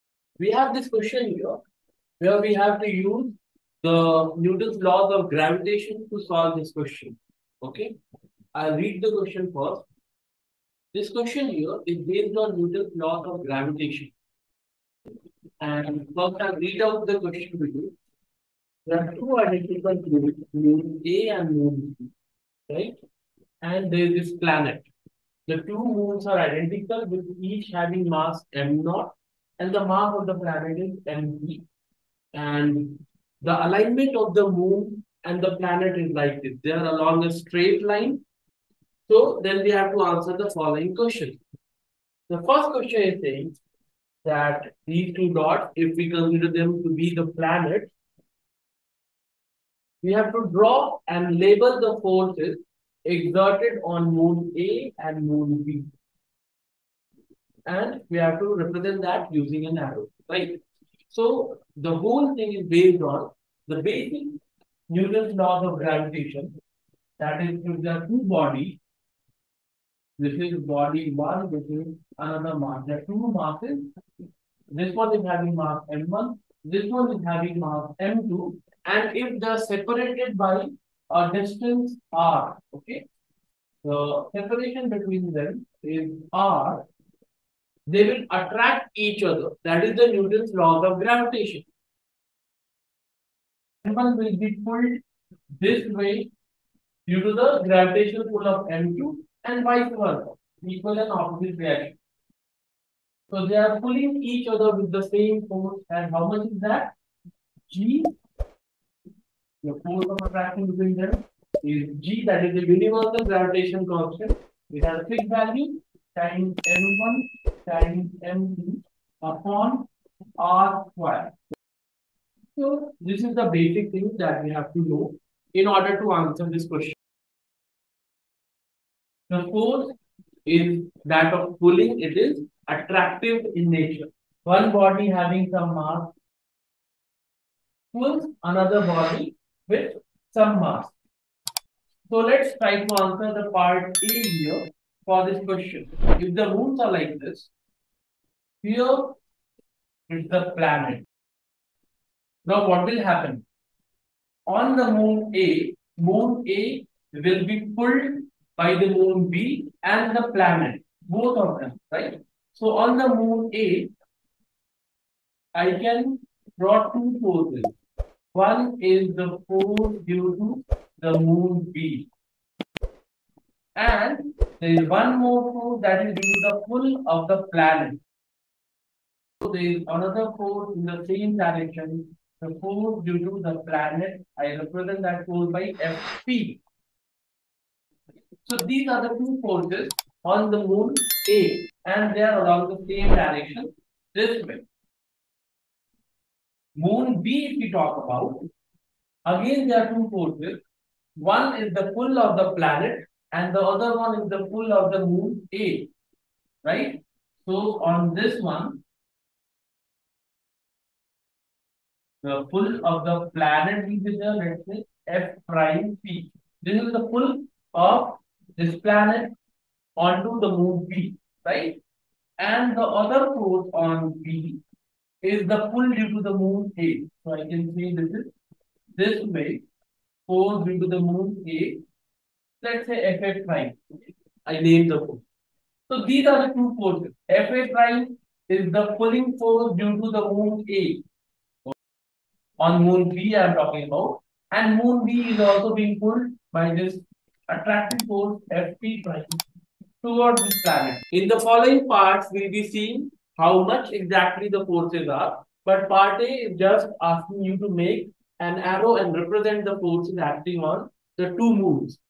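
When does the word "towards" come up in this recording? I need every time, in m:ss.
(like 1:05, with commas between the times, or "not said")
4:10.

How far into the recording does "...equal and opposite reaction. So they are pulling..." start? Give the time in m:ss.
1:40.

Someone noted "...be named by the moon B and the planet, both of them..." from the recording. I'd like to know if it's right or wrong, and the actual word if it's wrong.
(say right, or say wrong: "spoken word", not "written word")
wrong: "pulled", not "named".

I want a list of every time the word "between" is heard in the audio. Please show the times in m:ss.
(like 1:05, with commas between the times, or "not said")
1:24, 1:50.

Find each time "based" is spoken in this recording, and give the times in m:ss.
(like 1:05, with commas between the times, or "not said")
0:12, 1:02.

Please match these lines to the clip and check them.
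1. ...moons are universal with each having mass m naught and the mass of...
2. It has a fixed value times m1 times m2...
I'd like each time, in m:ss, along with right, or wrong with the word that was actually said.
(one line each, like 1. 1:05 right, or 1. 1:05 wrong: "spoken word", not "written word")
1. 0:25 wrong: "identical", not "universal"
2. 1:54 right.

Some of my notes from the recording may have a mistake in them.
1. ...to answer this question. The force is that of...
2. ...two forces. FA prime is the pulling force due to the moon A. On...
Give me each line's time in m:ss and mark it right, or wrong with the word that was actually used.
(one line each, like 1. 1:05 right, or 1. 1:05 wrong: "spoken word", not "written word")
1. 2:06 right
2. 3:56 right.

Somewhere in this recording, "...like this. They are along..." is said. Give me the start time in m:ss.
0:36.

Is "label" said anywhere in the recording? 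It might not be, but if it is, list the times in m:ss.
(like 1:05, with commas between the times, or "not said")
0:51.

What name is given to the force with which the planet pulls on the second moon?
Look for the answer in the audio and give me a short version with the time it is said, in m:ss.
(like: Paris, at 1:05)
F prime P, at 3:35.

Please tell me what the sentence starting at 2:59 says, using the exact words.
So there is another force in the same direction.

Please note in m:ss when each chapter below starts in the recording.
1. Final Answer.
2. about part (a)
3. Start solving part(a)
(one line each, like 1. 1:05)
1. 4:11
2. 0:43
3. 1:07.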